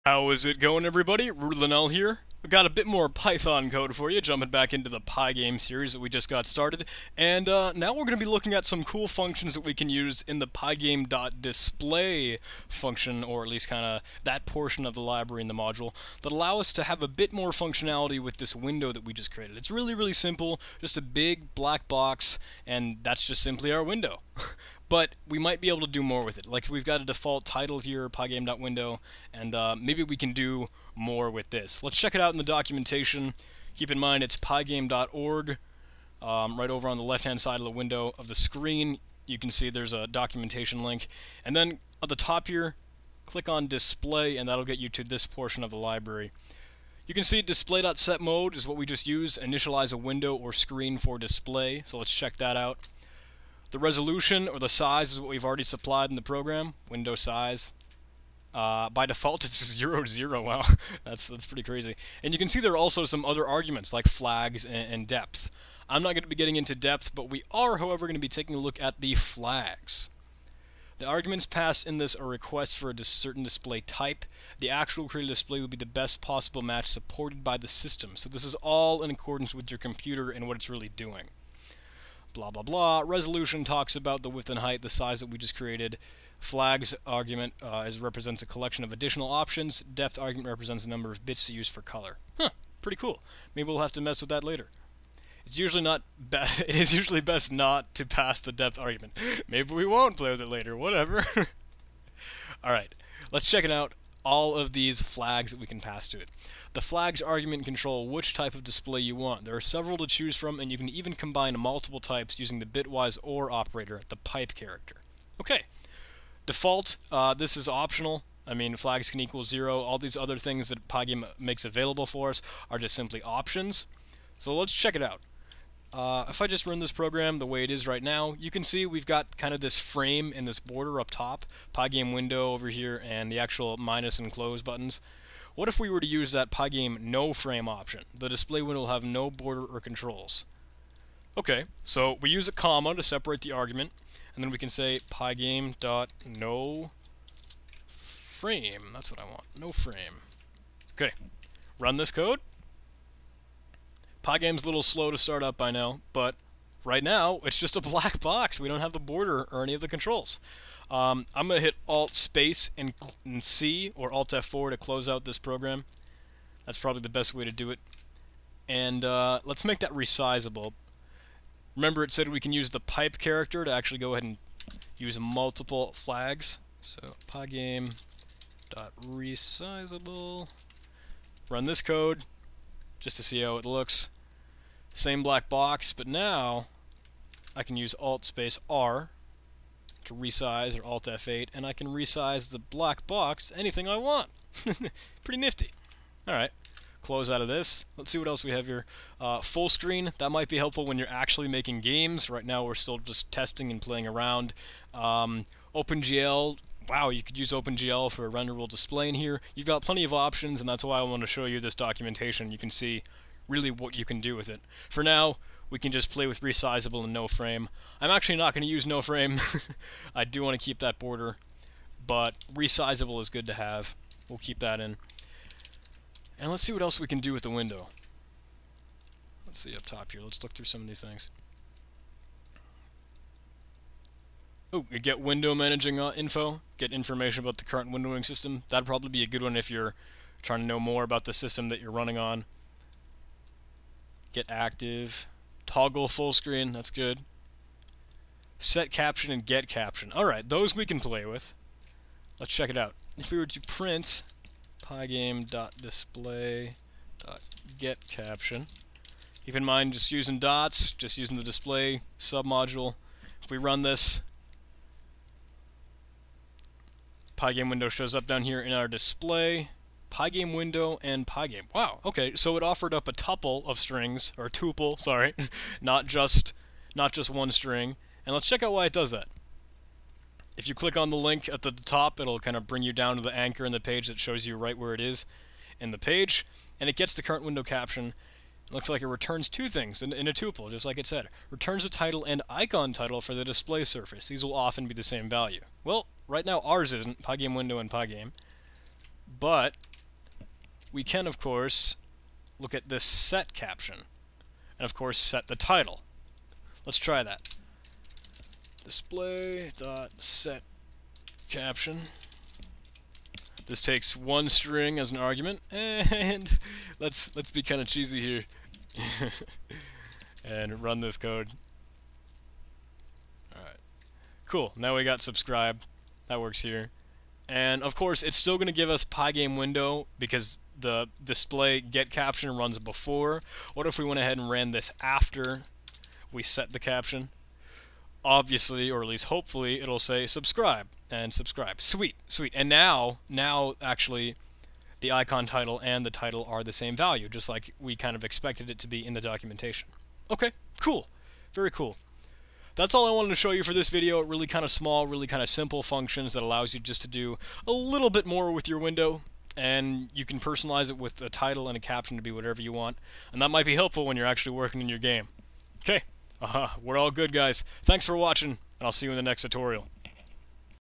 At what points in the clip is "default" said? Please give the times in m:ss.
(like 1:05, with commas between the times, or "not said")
0:27, 0:59, 1:56.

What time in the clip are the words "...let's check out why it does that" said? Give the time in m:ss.
4:38.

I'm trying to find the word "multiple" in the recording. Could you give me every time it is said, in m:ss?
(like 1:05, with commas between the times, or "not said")
1:51, 2:55.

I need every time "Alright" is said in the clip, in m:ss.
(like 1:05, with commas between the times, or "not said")
3:16, 4:10.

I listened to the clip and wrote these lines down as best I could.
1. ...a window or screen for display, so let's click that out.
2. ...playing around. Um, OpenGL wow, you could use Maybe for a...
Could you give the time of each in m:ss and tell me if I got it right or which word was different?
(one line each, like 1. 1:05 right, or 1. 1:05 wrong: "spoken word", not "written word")
1. 0:49 wrong: "check", not "click"
2. 3:23 wrong: "OpenGL", not "Maybe".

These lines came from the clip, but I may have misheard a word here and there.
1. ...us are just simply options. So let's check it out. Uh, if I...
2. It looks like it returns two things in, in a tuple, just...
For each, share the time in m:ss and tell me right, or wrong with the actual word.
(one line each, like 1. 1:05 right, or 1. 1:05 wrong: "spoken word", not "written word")
1. 2:02 right
2. 4:48 right.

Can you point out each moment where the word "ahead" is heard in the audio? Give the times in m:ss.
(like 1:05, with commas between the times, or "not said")
2:54, 5:34.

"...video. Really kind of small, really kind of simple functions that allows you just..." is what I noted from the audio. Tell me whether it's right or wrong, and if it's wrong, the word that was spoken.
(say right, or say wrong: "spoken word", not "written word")
right.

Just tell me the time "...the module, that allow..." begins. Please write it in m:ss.
0:15.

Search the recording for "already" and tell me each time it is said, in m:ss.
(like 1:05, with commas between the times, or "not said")
0:55.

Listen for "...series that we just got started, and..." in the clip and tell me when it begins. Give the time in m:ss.
0:05.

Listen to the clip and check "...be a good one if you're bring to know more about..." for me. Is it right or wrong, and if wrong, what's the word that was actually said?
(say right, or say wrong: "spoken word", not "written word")
wrong: "trying", not "bring".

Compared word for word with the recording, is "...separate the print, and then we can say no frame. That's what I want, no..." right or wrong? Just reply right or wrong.
wrong.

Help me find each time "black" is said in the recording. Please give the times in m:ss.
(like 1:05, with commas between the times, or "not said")
0:21, 2:37, 3:05, 3:12.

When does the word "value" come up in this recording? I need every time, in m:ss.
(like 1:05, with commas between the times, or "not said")
4:55, 5:46.